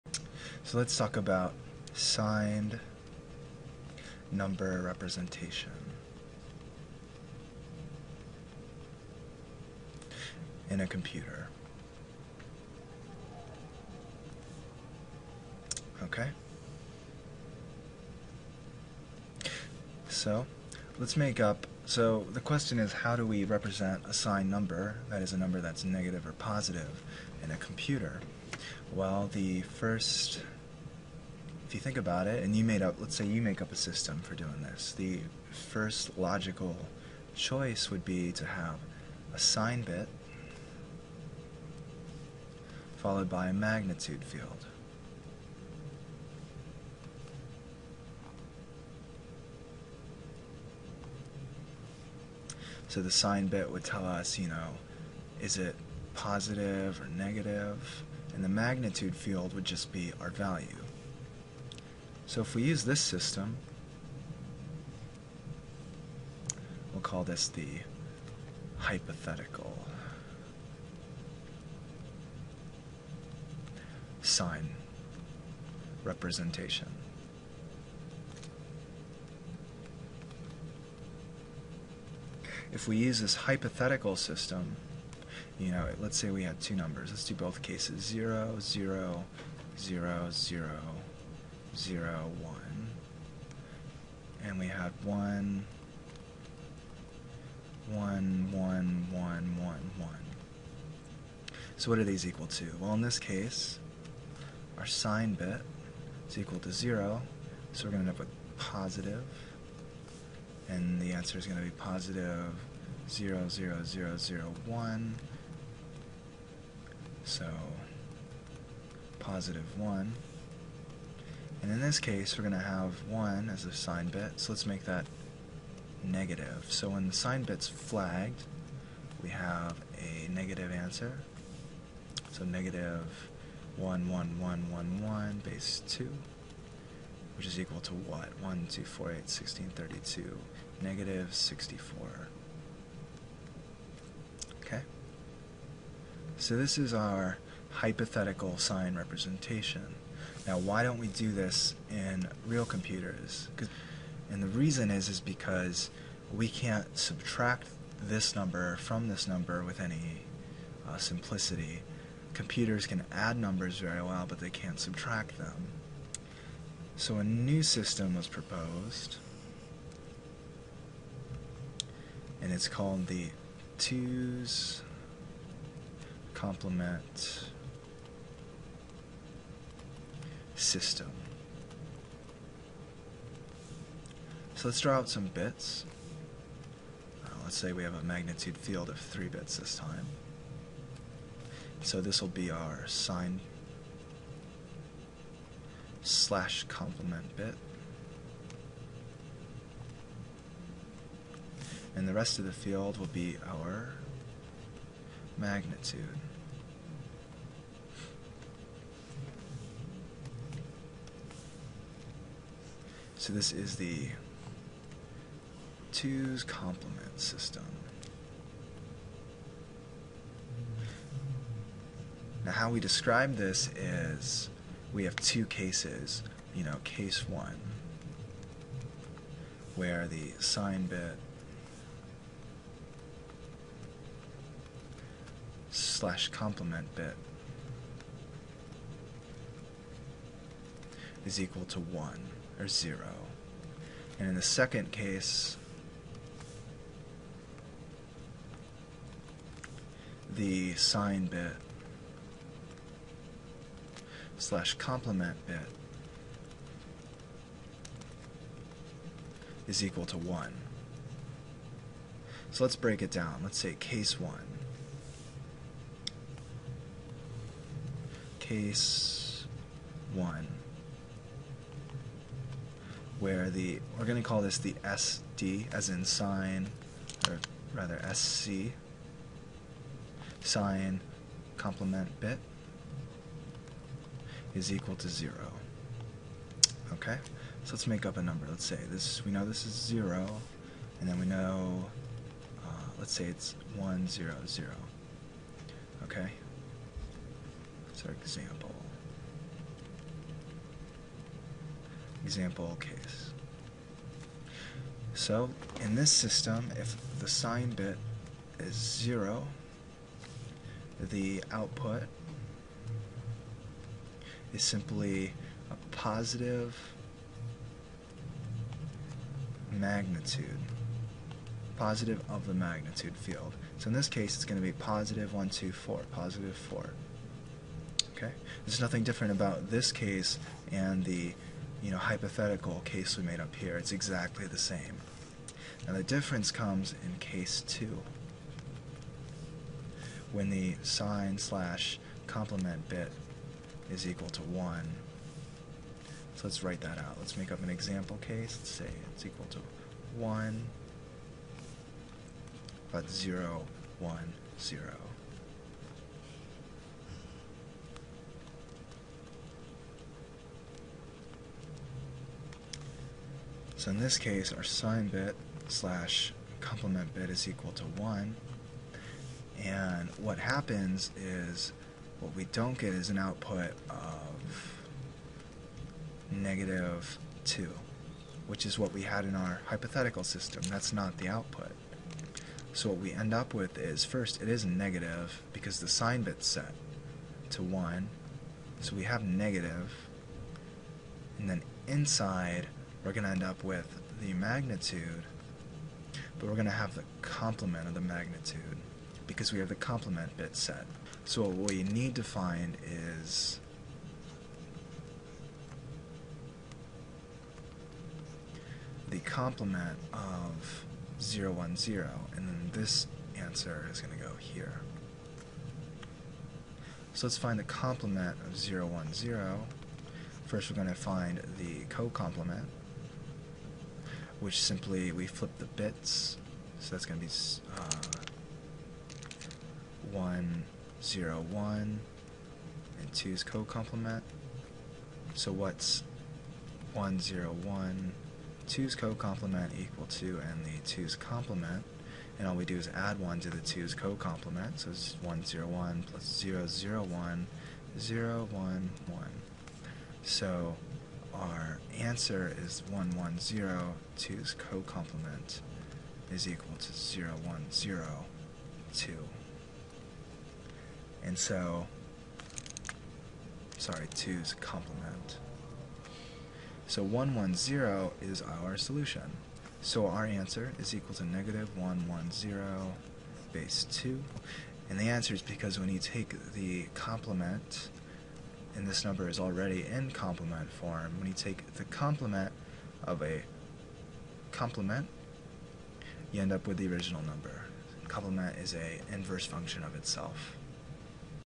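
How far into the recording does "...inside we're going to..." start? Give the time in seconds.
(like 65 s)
391 s.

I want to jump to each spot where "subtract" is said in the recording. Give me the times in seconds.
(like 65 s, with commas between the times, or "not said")
156 s, 164 s.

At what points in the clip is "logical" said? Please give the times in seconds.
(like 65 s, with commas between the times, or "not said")
36 s.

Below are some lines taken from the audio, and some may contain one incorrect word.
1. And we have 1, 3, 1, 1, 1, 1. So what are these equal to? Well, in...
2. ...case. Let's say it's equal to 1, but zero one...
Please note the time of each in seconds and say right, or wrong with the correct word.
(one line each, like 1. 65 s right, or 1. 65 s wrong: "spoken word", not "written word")
1. 94 s wrong: "1", not "3"
2. 348 s right.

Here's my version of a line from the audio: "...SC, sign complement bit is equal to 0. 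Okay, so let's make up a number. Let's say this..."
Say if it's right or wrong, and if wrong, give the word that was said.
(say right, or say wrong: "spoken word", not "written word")
right.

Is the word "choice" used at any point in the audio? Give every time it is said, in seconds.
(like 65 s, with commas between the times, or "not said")
37 s.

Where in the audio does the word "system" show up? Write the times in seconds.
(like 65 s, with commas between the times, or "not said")
33 s, 63 s, 84 s, 167 s, 180 s, 217 s, 306 s, 380 s.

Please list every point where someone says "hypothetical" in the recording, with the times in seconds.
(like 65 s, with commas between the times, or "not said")
68 s, 83 s, 147 s, 331 s, 379 s.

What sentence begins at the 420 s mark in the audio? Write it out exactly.
First we're going to find the co-complement which simply we flip the bits.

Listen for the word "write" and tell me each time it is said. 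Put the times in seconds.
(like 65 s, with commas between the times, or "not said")
346 s.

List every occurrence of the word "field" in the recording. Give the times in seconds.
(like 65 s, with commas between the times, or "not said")
44 s, 59 s, 188 s, 202 s, 323 s.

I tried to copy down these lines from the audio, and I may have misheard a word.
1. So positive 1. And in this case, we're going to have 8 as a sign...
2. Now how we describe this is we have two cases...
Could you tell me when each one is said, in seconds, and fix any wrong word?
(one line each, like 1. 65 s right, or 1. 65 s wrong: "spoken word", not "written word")
1. 117 s wrong: "1", not "8"
2. 222 s right.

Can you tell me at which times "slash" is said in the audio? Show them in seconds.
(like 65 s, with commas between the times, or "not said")
196 s, 235 s, 254 s, 341 s, 365 s.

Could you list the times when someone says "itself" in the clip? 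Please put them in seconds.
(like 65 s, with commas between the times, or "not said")
489 s.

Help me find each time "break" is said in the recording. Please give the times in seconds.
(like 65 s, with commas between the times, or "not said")
262 s.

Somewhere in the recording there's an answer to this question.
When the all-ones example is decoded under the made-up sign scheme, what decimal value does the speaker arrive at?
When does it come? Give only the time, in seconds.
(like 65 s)
140 s.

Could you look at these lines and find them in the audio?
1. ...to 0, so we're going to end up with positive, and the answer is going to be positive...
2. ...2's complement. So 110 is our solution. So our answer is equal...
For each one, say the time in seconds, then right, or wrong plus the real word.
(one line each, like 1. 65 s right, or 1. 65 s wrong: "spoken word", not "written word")
1. 106 s right
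2. 464 s right.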